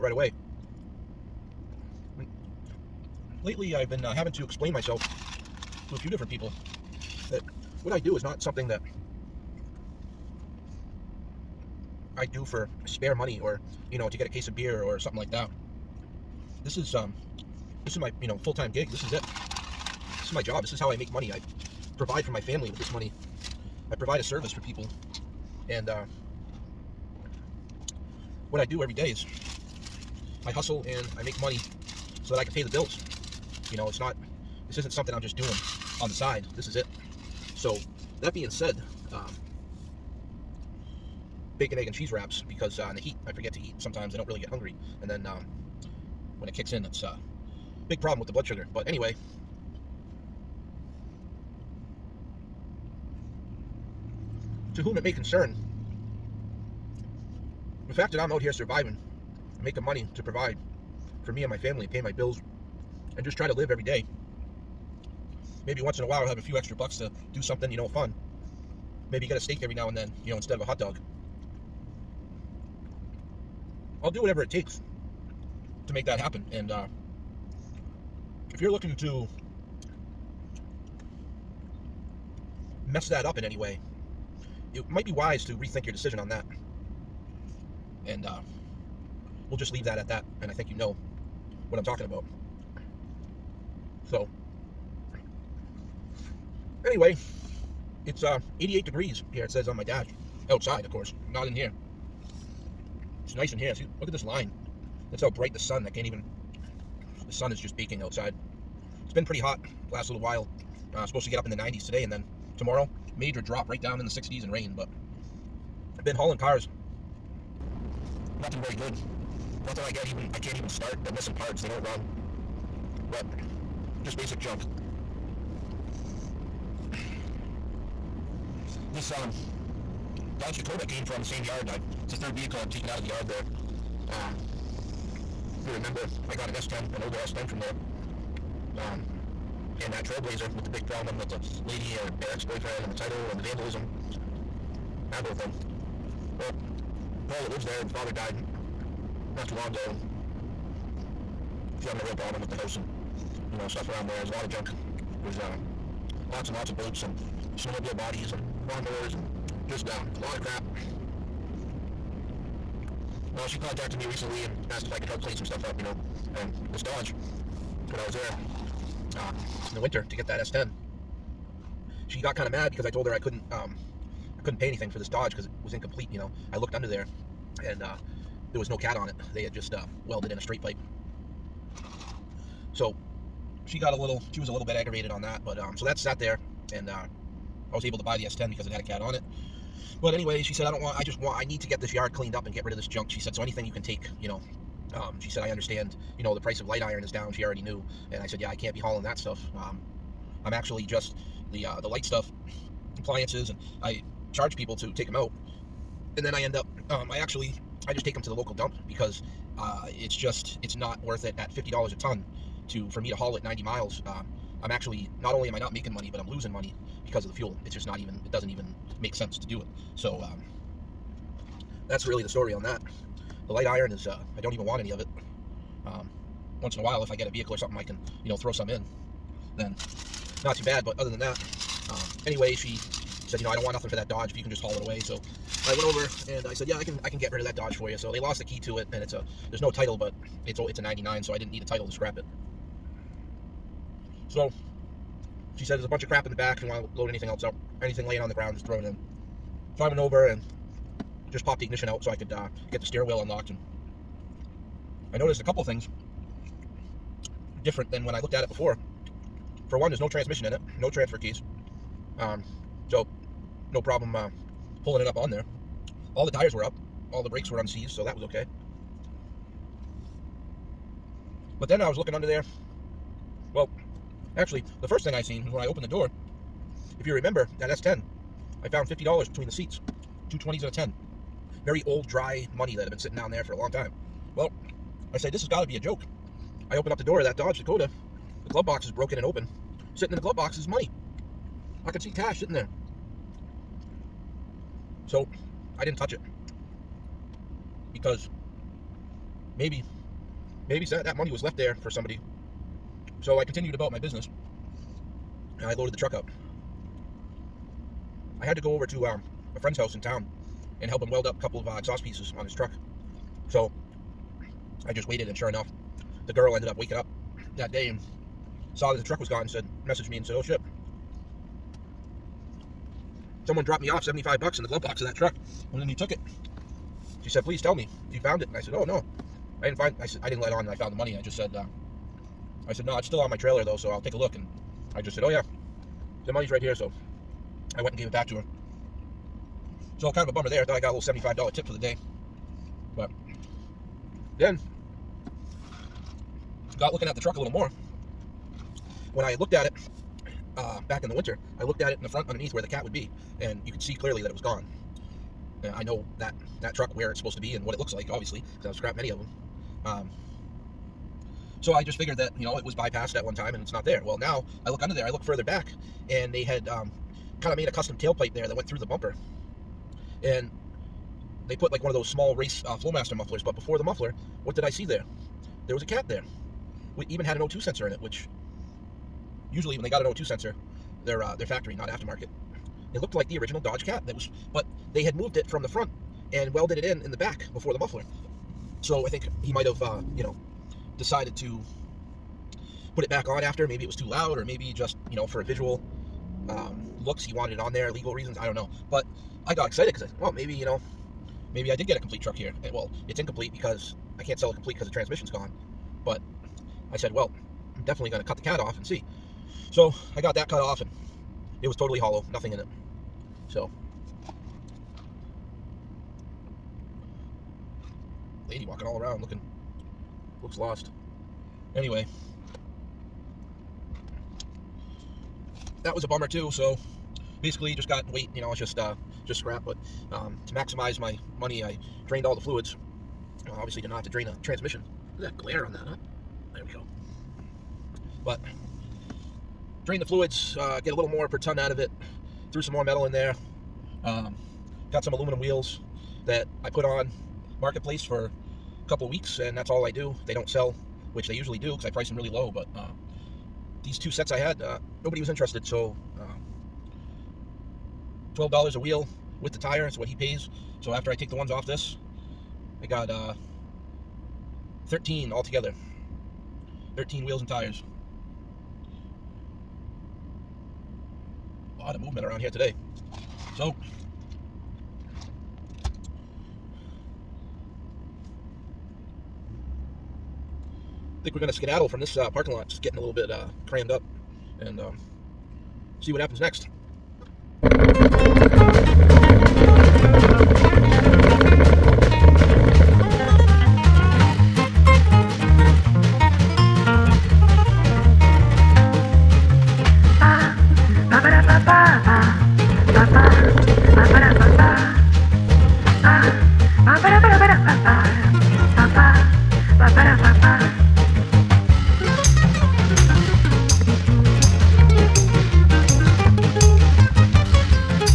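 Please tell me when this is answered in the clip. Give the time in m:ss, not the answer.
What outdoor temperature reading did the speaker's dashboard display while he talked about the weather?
1:38.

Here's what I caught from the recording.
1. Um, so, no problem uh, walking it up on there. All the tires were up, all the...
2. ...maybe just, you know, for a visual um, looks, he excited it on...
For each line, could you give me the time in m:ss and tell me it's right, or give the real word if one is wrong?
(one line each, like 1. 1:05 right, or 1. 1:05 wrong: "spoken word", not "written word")
1. 4:22 wrong: "pulling", not "walking"
2. 6:34 wrong: "wanted", not "excited".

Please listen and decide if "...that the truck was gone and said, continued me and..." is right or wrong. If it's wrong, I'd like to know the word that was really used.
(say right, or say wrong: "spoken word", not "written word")
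wrong: "messaged", not "continued".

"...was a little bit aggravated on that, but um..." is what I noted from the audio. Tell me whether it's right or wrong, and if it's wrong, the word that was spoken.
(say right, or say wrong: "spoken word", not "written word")
right.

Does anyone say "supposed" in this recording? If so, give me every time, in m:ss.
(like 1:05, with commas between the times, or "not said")
1:51, 5:57.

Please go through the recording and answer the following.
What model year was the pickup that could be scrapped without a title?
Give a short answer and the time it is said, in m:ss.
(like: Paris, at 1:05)
1999, at 4:00.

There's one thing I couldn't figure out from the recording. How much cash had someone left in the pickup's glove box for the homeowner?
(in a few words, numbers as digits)
$75.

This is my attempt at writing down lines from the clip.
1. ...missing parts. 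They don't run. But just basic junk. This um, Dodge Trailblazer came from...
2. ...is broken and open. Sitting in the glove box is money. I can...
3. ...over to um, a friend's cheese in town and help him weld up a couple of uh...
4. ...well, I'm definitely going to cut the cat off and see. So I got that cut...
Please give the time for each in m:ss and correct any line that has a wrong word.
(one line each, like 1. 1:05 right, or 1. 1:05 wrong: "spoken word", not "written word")
1. 2:01 wrong: "Dakota", not "Trailblazer"
2. 4:48 right
3. 5:08 wrong: "house", not "cheese"
4. 6:47 right.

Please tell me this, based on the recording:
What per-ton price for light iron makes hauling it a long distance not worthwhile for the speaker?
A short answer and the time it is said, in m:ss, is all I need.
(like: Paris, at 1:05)
$50 a ton, at 3:31.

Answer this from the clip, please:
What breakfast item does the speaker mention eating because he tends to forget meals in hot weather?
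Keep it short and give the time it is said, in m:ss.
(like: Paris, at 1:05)
Bacon, egg, and cheese wraps, at 0:41.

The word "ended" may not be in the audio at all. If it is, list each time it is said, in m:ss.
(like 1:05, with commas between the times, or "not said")
5:16.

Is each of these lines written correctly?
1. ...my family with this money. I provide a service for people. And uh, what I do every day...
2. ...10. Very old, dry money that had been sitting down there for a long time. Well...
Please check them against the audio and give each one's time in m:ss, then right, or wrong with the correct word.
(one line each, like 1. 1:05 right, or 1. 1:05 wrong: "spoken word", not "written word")
1. 0:22 right
2. 4:40 right.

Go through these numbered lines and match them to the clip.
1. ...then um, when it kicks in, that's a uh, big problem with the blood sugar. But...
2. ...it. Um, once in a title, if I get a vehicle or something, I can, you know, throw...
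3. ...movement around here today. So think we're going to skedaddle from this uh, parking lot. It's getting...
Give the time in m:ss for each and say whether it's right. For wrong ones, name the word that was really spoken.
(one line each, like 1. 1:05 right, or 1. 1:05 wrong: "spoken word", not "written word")
1. 0:45 right
2. 3:44 wrong: "while", not "title"
3. 7:51 right.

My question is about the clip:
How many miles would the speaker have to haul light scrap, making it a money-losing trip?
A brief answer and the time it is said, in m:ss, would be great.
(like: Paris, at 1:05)
90 miles, at 3:33.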